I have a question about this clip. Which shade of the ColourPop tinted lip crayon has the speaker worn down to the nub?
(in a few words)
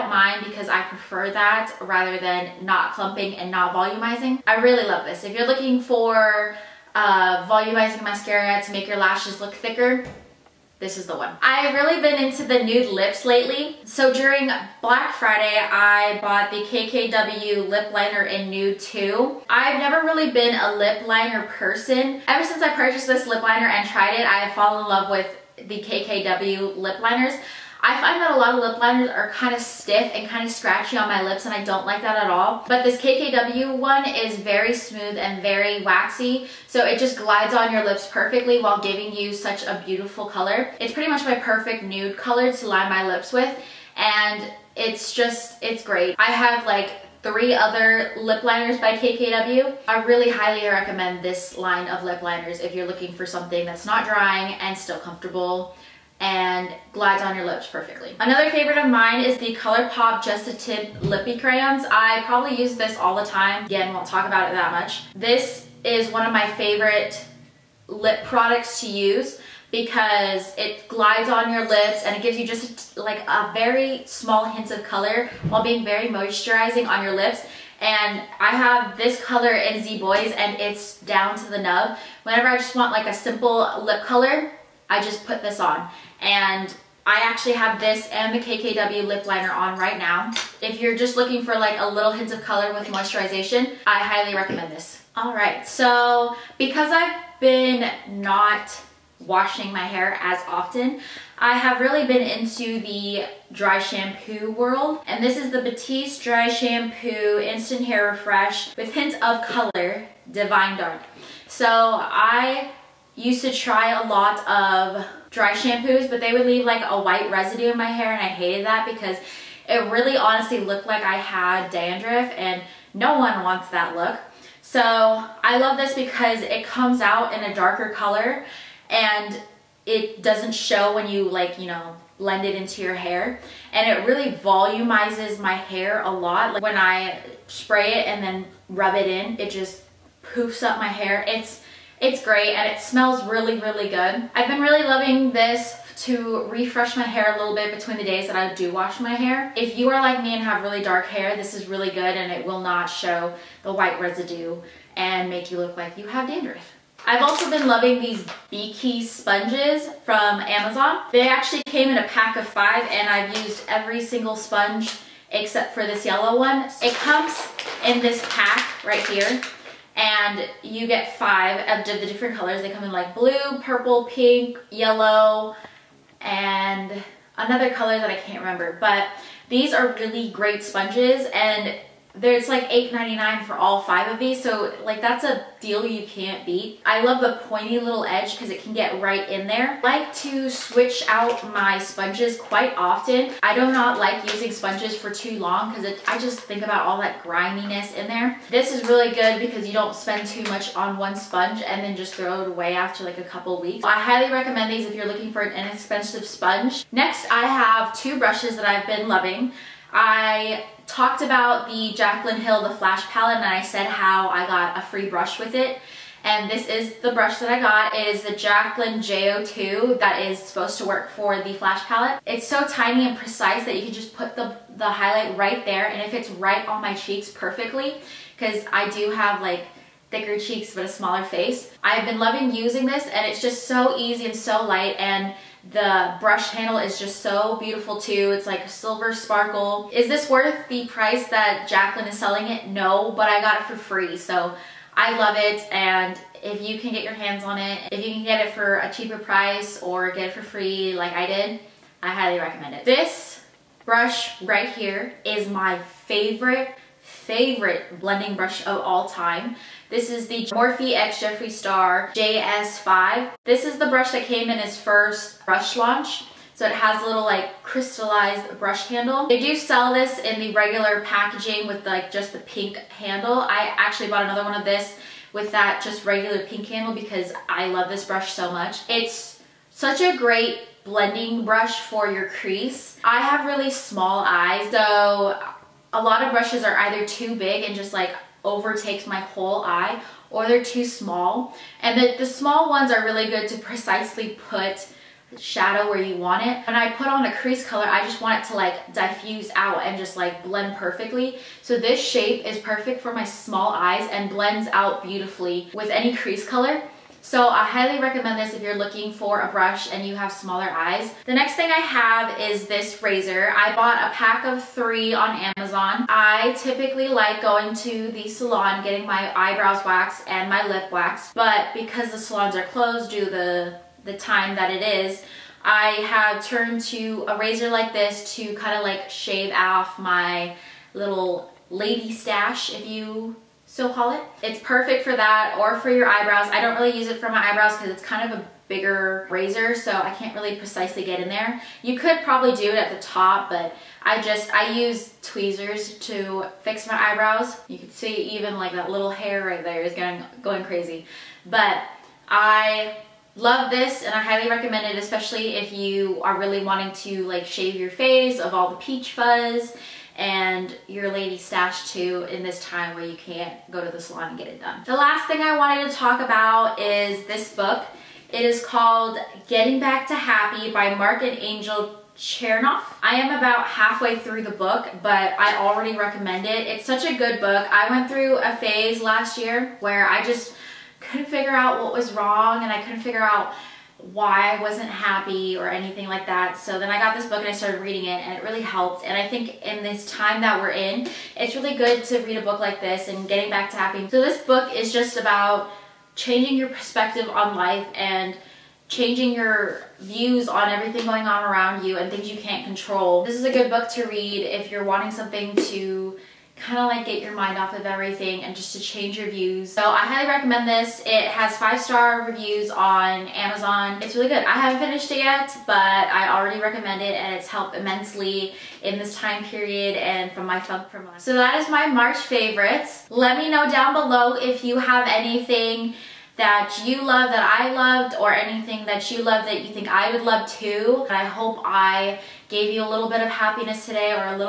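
Z Boys.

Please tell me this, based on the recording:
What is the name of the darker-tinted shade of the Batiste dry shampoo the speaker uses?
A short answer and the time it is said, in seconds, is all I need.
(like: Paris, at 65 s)
Divine Dark, at 110 s.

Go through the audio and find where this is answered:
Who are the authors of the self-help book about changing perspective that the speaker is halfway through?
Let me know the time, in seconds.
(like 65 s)
370 s.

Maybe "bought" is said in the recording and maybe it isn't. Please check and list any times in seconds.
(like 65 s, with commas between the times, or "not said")
16 s, 274 s, 313 s.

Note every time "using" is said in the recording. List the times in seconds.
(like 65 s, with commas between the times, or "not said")
194 s, 232 s.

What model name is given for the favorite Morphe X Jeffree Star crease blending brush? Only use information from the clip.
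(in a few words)
JS5.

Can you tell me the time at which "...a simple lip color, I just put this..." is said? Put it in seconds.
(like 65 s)
83 s.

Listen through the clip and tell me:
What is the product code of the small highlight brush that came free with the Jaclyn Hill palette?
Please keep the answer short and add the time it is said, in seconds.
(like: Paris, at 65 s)
JO2, at 218 s.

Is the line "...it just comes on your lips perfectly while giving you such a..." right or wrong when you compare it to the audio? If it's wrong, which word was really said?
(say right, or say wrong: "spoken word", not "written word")
wrong: "glides", not "comes".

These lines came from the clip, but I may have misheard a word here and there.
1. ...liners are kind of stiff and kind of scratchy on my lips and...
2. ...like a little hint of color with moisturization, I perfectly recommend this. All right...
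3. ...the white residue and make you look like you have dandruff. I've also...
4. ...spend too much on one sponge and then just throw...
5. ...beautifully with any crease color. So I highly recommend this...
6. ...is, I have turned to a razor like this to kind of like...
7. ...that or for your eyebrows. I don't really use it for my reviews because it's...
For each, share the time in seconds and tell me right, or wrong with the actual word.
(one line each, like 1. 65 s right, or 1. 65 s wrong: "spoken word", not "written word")
1. 28 s right
2. 91 s wrong: "highly", not "perfectly"
3. 153 s right
4. 199 s right
5. 305 s right
6. 324 s right
7. 335 s wrong: "eyebrows", not "reviews".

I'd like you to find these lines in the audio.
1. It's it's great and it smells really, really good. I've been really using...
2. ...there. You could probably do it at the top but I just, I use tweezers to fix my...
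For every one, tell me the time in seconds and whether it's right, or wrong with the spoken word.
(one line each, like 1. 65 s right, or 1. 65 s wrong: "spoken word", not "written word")
1. 141 s wrong: "loving", not "using"
2. 341 s right.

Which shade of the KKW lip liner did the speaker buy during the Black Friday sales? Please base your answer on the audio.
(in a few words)
Nude 2.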